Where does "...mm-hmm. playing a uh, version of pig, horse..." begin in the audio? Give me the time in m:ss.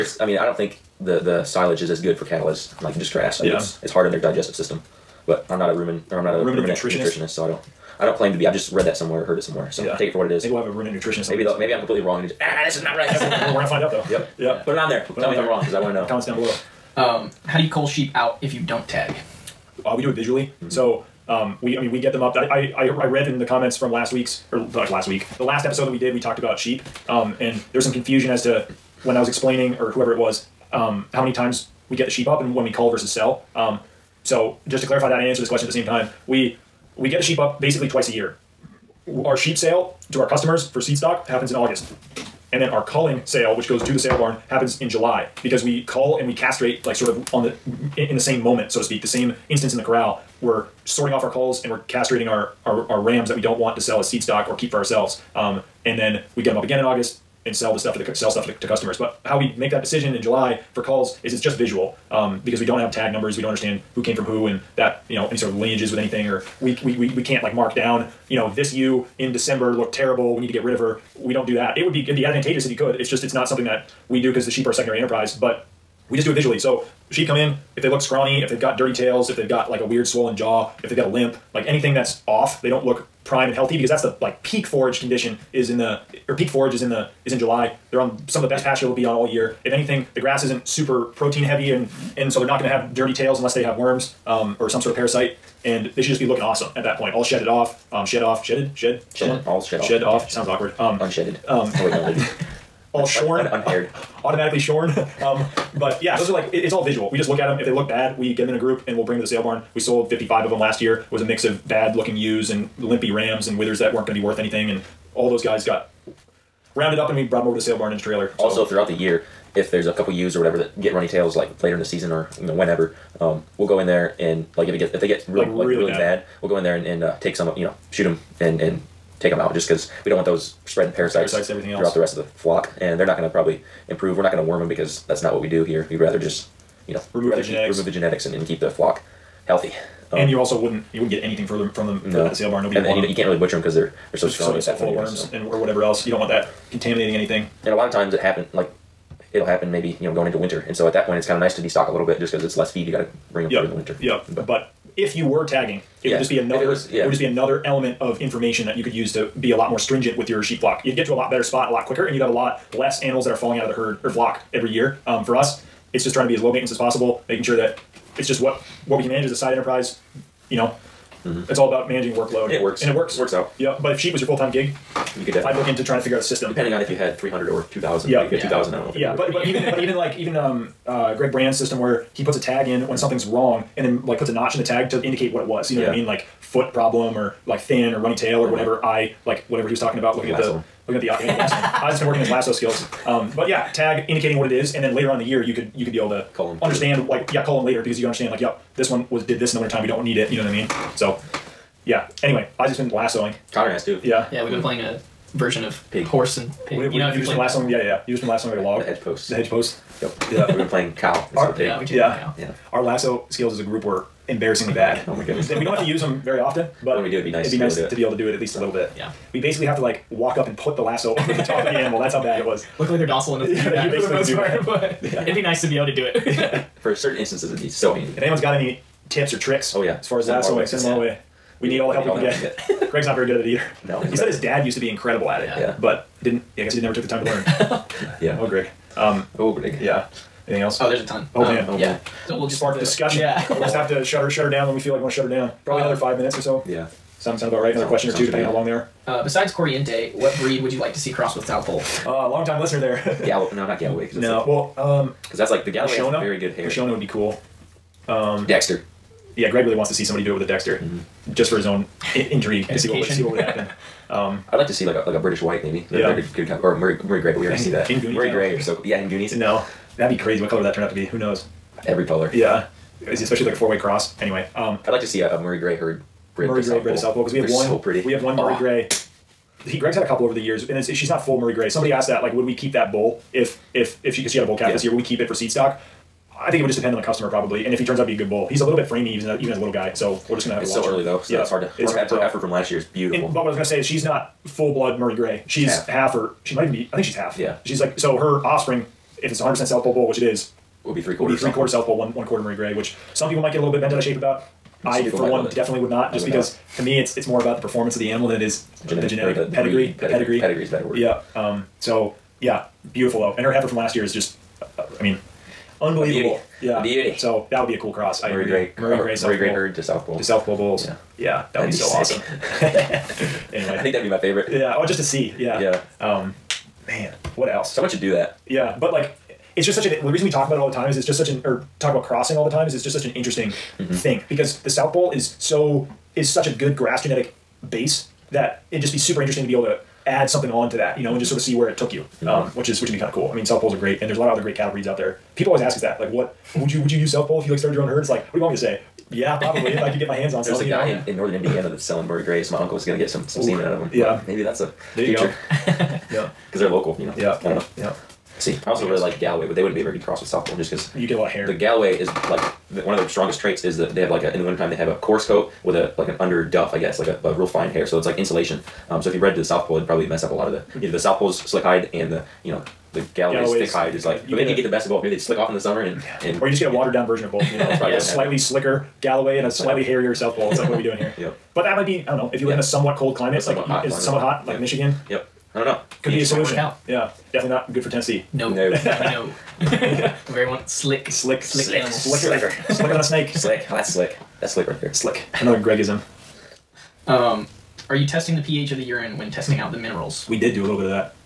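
3:24.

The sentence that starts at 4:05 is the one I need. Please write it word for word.
Probably um, another five minutes or so.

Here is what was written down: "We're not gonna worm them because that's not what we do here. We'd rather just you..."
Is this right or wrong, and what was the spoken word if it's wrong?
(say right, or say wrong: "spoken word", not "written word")
right.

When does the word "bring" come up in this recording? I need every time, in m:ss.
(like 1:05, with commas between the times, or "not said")
1:49, 2:33.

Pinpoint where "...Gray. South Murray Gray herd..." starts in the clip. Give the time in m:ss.
5:19.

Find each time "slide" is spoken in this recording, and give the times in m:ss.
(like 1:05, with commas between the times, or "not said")
not said.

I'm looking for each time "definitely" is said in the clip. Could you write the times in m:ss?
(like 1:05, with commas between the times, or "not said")
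2:55, 5:05, 6:27.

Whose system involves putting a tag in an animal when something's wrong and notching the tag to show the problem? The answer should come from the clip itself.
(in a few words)
Greg Brann.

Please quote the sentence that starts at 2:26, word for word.
You don't want that contaminating anything.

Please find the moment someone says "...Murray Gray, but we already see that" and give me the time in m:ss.
4:27.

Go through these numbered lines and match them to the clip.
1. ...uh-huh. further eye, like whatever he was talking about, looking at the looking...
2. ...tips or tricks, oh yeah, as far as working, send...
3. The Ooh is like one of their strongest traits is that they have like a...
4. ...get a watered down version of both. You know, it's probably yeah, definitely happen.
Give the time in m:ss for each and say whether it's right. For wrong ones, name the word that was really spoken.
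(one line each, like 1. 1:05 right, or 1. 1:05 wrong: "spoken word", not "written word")
1. 3:08 wrong: "whatever", not "further"
2. 3:49 wrong: "lassoing", not "working"
3. 6:01 wrong: "Galloway", not "Ooh"
4. 6:16 wrong: "slightly", not "definitely".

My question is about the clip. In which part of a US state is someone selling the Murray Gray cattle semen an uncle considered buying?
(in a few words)
northern Indiana.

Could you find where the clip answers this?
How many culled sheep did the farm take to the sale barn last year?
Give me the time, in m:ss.
1:49.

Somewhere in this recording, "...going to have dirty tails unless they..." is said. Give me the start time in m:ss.
1:32.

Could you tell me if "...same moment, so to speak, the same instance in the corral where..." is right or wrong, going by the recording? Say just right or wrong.
right.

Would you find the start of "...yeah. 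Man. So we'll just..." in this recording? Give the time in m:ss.
4:01.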